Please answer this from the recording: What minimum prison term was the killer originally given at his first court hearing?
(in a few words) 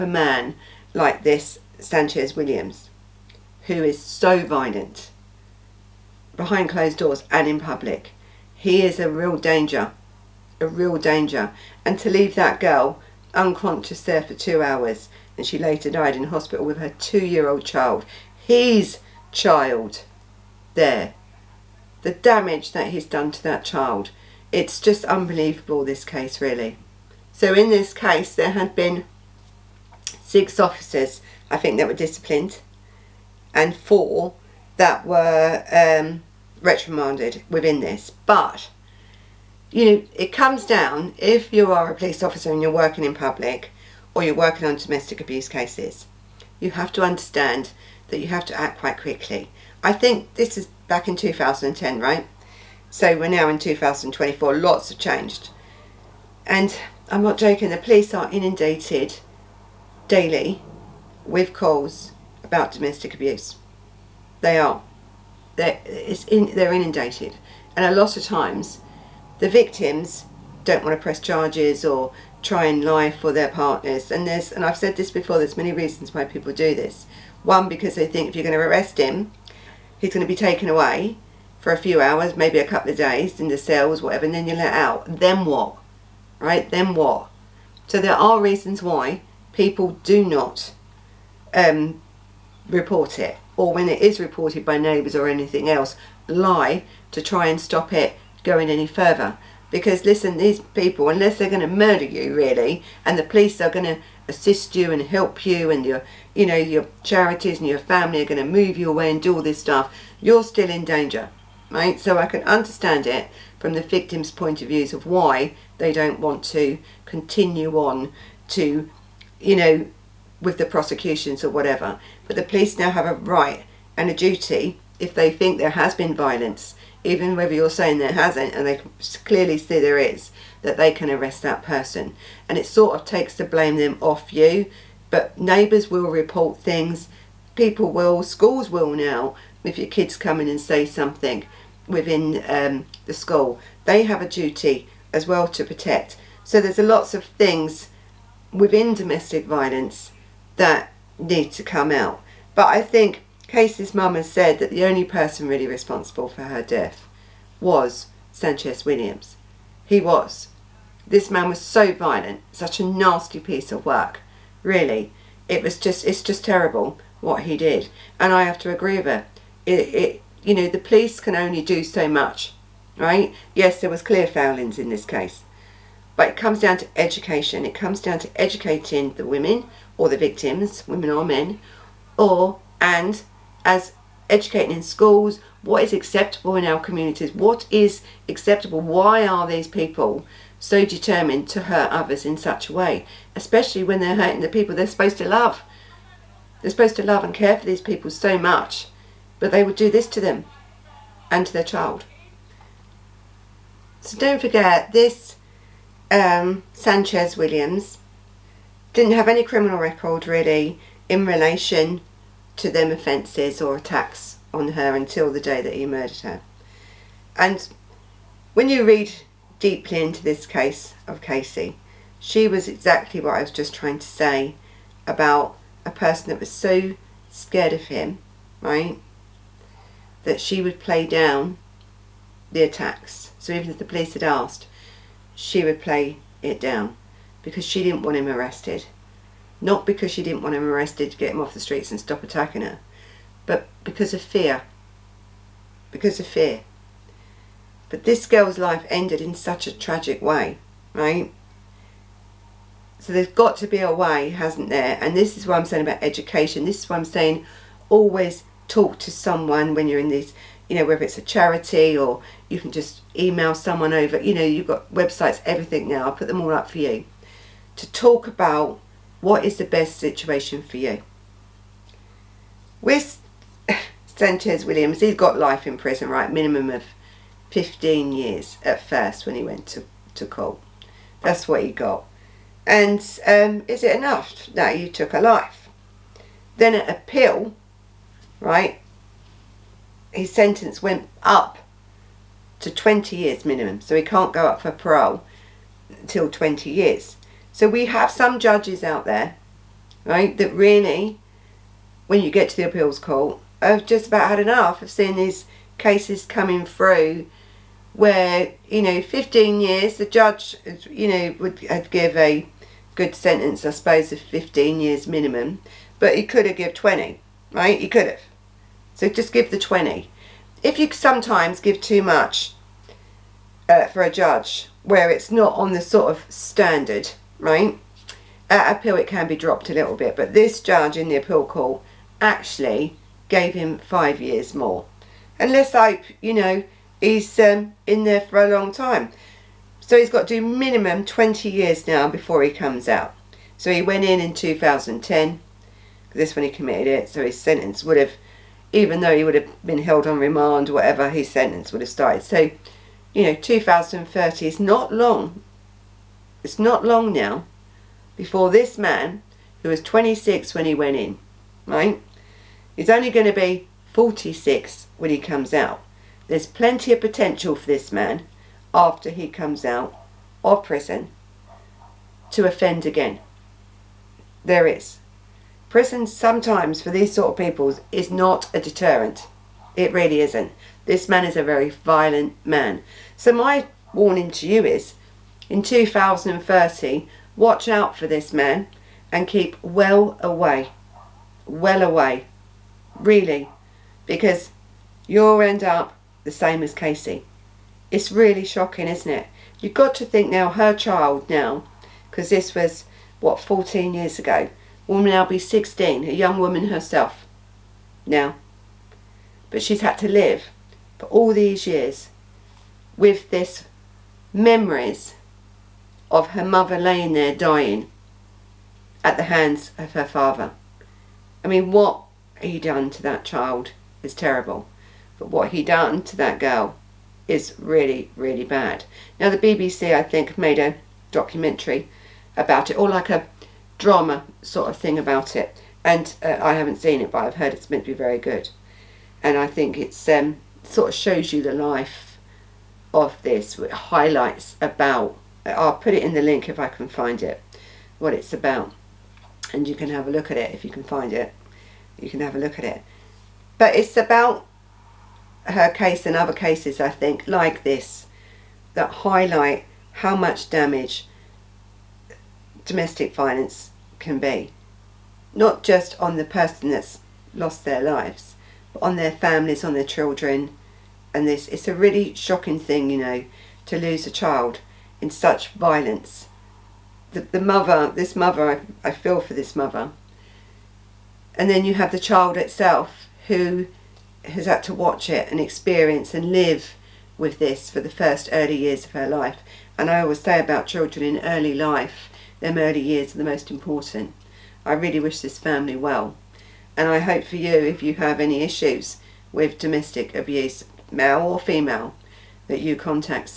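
15 years.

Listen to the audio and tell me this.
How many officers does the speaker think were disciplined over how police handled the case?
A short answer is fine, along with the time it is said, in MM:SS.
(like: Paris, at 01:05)
6, at 00:30.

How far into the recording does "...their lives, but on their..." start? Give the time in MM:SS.
07:47.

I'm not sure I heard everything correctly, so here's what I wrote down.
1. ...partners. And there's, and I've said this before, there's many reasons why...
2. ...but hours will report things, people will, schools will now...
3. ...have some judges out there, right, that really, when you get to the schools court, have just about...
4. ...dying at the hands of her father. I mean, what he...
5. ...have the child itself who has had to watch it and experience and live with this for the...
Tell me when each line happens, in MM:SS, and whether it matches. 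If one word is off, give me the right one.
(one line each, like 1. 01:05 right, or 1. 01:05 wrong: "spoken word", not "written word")
1. 01:13 right
2. 02:15 wrong: "neighbours", not "hours"
3. 04:57 wrong: "appeals", not "schools"
4. 06:57 right
5. 08:01 right.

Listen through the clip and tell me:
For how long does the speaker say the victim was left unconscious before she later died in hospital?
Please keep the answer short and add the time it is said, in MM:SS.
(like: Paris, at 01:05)
two hours, at 00:14.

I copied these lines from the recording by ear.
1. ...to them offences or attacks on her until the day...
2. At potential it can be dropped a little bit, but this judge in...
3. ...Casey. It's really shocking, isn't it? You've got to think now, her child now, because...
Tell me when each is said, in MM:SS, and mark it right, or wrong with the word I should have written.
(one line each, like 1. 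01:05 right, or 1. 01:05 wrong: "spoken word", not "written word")
1. 03:32 right
2. 05:28 wrong: "appeal", not "potential"
3. 06:36 right.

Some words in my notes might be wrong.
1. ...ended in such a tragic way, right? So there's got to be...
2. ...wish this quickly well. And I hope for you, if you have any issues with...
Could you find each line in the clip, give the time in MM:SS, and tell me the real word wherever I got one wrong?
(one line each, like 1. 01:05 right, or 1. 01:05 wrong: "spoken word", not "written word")
1. 04:08 right
2. 08:14 wrong: "family", not "quickly".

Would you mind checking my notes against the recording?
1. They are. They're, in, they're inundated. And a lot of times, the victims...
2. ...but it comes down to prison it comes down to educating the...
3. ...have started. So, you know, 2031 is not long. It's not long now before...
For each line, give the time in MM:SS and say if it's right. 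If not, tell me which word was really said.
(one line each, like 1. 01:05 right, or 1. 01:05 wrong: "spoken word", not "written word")
1. 01:04 right
2. 02:56 wrong: "education", not "prison"
3. 05:51 wrong: "2030", not "2031".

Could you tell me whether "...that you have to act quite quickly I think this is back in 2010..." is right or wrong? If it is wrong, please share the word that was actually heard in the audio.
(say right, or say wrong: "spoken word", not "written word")
right.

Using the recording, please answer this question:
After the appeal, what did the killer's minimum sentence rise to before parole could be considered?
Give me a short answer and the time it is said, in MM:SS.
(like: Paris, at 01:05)
20 years, at 04:52.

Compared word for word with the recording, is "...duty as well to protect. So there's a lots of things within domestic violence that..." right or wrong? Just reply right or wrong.
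right.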